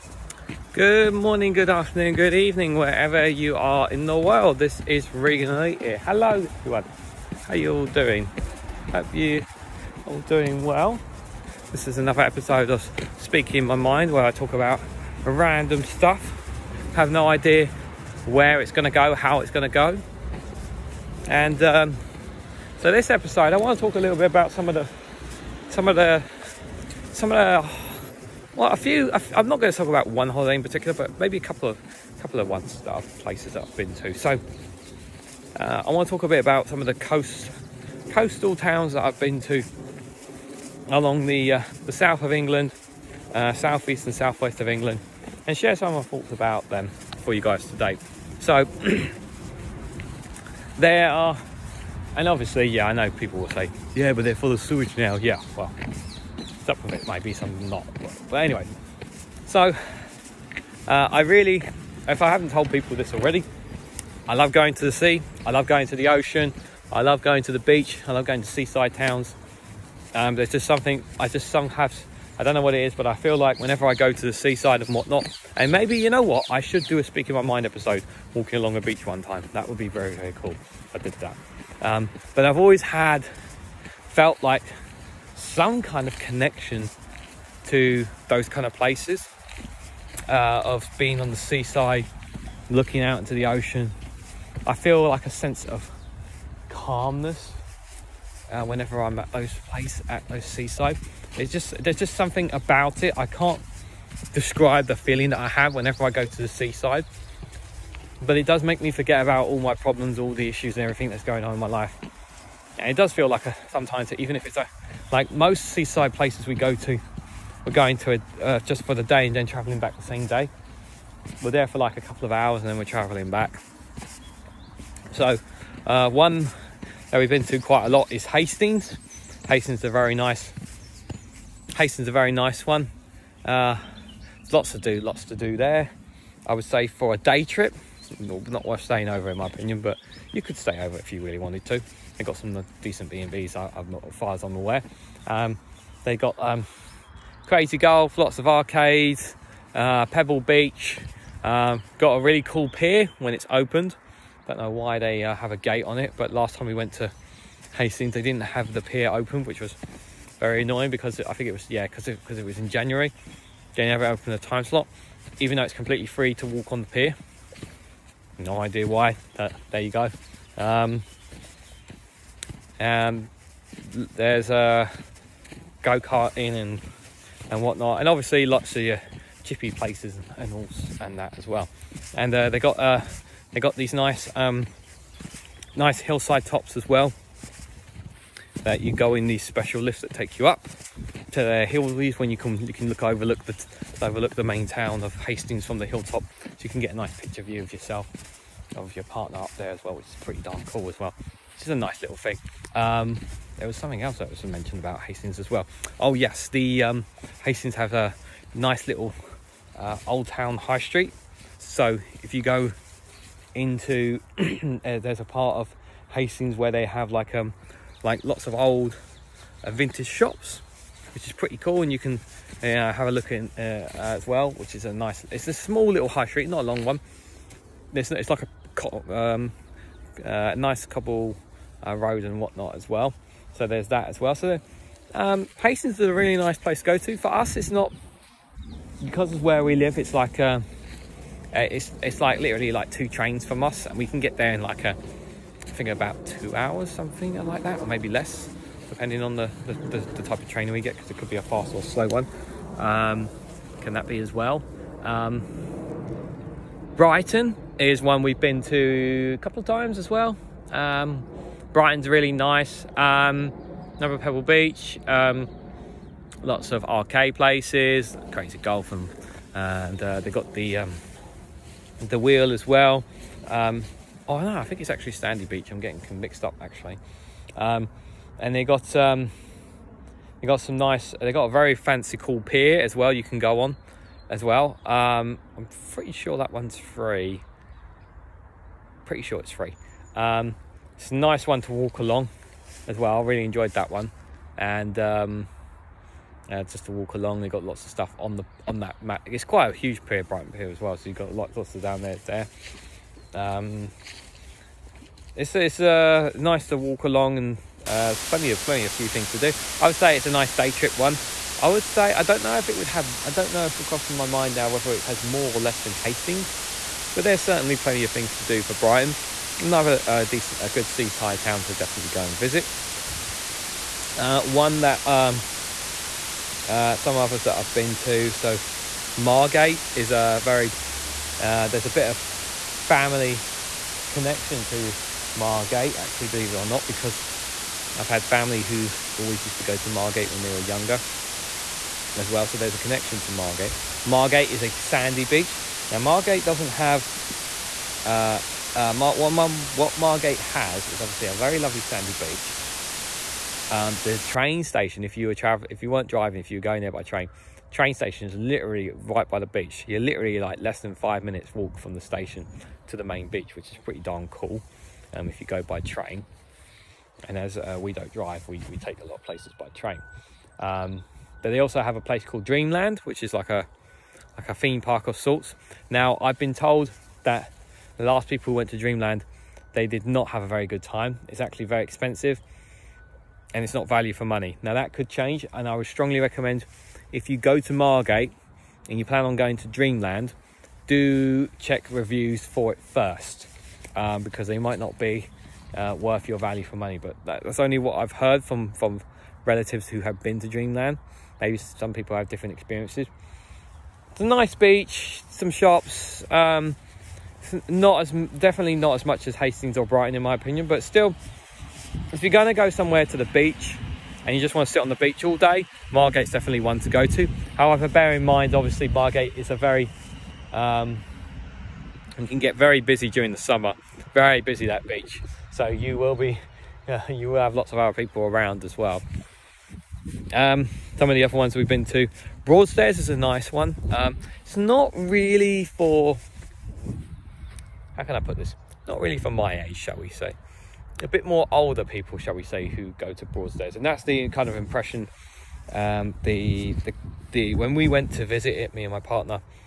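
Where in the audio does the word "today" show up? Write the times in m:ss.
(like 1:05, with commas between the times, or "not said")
0:47.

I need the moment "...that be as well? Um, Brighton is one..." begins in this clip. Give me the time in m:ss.
4:13.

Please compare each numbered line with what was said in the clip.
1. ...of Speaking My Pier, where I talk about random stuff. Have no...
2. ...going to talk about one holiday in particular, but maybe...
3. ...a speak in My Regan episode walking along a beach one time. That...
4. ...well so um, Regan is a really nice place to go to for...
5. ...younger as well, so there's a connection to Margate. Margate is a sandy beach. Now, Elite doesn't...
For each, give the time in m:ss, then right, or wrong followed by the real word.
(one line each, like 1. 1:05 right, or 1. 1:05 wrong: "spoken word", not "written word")
1. 0:12 wrong: "Mind", not "Pier"
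2. 0:29 right
3. 1:16 wrong: "Mind", not "Regan"
4. 3:54 wrong: "Hastings", not "Regan"
5. 5:40 wrong: "Margate", not "Elite".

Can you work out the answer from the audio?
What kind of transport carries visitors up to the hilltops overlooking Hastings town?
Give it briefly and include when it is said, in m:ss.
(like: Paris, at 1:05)
Special lifts, at 3:09.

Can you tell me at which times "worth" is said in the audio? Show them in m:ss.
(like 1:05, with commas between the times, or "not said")
2:18, 6:35.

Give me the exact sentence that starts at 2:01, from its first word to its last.
We're there for like a couple of hours and then we're traveling back.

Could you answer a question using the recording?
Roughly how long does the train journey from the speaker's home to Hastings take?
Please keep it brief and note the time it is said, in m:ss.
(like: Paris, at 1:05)
About 2 hours, at 4:05.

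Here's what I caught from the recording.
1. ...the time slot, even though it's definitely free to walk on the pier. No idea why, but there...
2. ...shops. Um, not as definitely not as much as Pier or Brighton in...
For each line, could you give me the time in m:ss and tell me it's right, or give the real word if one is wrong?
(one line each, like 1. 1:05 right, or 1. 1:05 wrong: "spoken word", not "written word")
1. 2:44 wrong: "completely", not "definitely"
2. 6:45 wrong: "Hastings", not "Pier".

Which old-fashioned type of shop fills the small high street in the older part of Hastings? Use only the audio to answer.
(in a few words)
Vintage shops.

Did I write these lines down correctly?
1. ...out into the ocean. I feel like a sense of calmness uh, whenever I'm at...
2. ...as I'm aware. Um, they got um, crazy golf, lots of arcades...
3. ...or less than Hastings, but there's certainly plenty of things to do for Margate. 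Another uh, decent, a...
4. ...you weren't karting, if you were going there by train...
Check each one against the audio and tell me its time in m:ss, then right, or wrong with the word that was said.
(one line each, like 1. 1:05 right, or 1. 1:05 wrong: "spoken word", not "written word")
1. 1:33 right
2. 2:24 right
3. 5:15 wrong: "Brighton", not "Margate"
4. 5:55 wrong: "driving", not "karting".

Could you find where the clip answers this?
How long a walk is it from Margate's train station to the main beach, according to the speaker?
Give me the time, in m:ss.
6:00.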